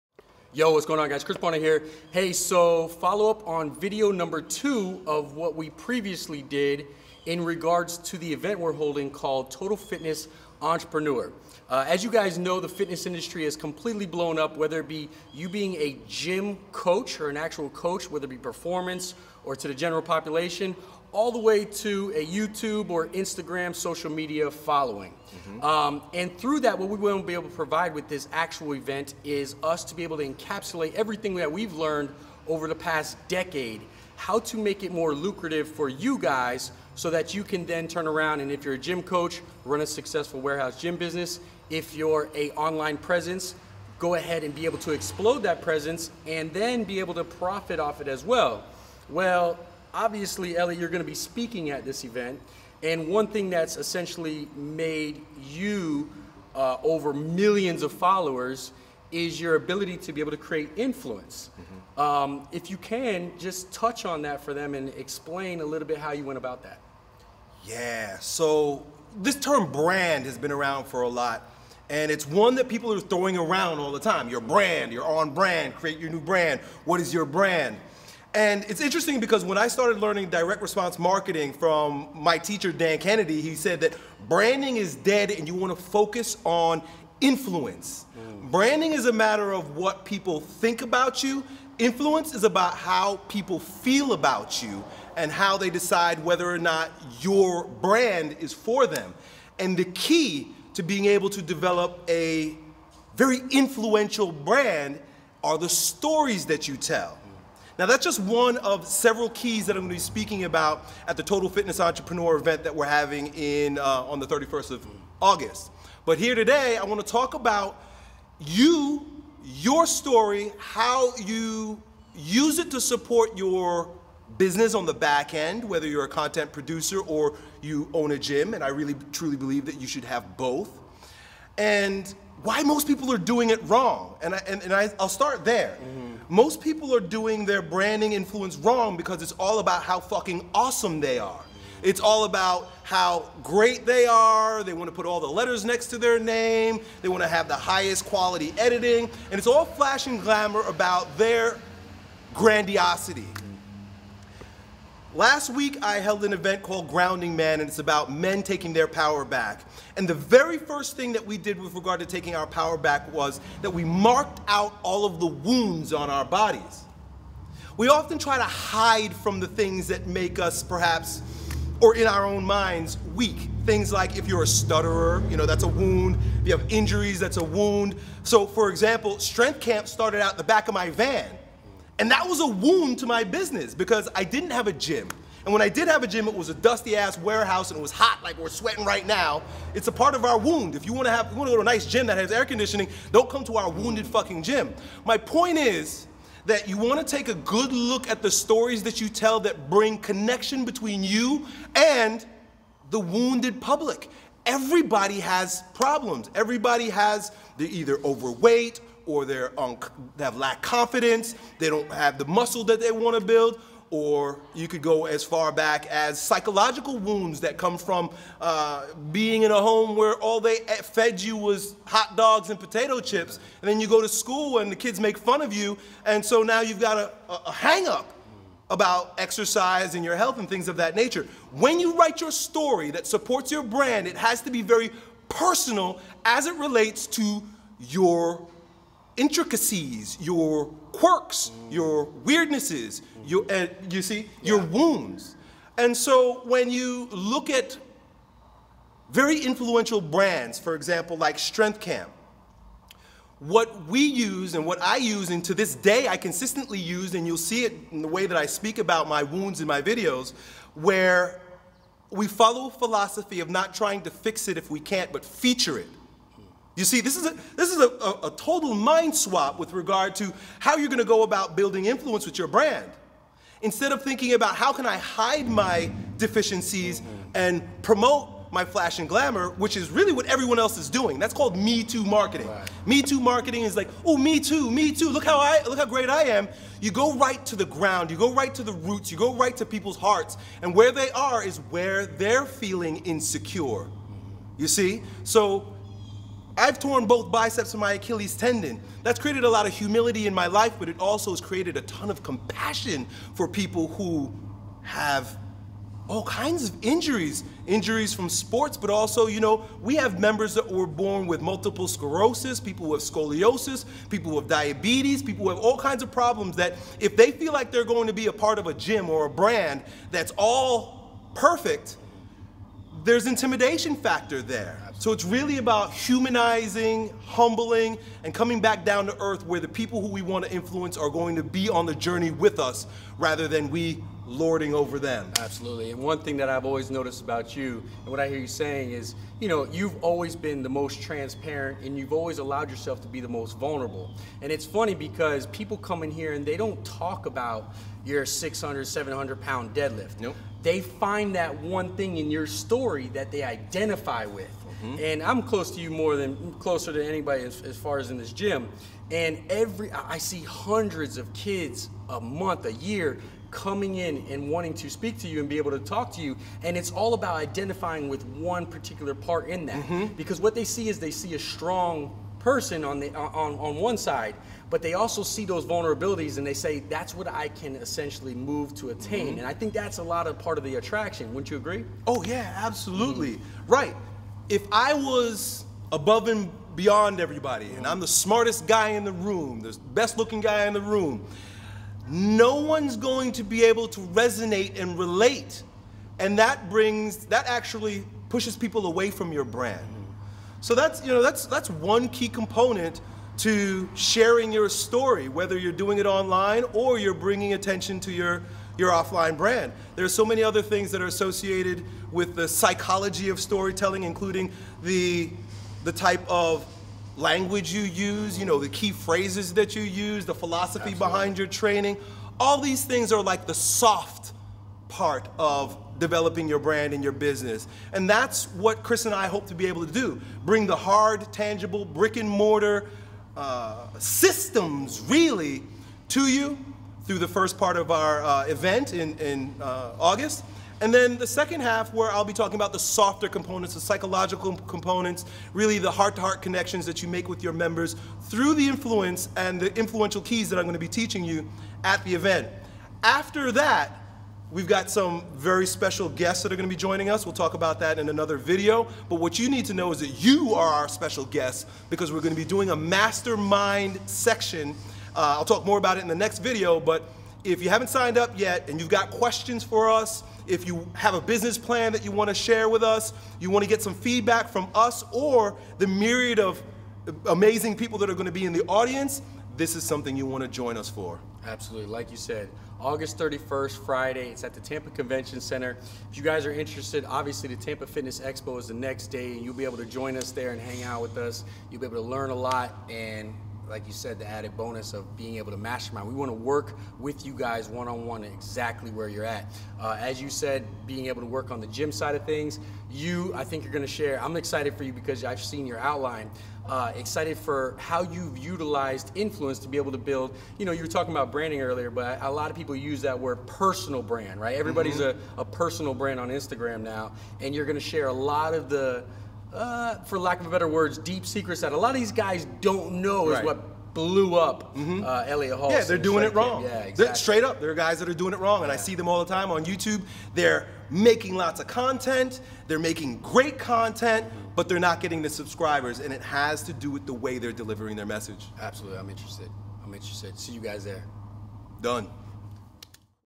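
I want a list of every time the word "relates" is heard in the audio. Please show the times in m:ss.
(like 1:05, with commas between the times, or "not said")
3:56, 6:34.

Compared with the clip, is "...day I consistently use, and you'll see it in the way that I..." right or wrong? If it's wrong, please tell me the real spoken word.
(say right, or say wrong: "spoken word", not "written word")
right.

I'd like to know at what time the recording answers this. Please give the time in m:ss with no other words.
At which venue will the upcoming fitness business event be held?
8:04.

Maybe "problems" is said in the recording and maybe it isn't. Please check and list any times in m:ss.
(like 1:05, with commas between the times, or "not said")
3:25, 5:16.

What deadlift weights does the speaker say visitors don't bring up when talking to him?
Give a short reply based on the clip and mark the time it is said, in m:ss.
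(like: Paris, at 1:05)
600-700 pounds, at 5:48.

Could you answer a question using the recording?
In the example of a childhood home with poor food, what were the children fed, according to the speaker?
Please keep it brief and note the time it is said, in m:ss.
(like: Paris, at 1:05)
hot dogs and potato chips, at 3:41.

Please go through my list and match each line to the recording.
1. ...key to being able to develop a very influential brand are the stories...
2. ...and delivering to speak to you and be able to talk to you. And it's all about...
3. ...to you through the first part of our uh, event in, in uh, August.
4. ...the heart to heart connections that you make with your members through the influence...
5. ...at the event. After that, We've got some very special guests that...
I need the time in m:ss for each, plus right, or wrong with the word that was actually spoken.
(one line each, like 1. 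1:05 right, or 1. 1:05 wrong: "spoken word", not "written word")
1. 1:39 right
2. 6:04 wrong: "wanting", not "delivering"
3. 7:16 right
4. 7:25 right
5. 7:31 right.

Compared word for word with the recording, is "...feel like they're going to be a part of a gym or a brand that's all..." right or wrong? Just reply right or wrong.
right.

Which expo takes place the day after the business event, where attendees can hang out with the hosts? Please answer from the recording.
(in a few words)
Tampa Fitness Expo.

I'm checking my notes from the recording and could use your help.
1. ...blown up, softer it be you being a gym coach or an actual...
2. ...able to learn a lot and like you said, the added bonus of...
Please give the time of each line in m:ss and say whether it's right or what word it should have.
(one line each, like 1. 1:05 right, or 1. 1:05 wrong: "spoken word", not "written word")
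1. 0:14 wrong: "whether", not "softer"
2. 8:11 right.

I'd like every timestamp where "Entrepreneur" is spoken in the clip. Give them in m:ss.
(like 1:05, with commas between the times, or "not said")
0:10, 1:51.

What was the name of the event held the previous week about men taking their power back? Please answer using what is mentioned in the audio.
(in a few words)
Grounding Man.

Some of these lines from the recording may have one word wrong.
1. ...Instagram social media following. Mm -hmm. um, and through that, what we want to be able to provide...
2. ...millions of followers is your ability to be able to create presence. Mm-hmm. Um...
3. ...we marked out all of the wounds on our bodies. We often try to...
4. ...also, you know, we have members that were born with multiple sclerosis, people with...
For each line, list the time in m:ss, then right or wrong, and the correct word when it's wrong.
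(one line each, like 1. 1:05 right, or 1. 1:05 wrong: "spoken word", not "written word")
1. 0:23 right
2. 0:57 wrong: "influence", not "presence"
3. 2:43 right
4. 5:08 right.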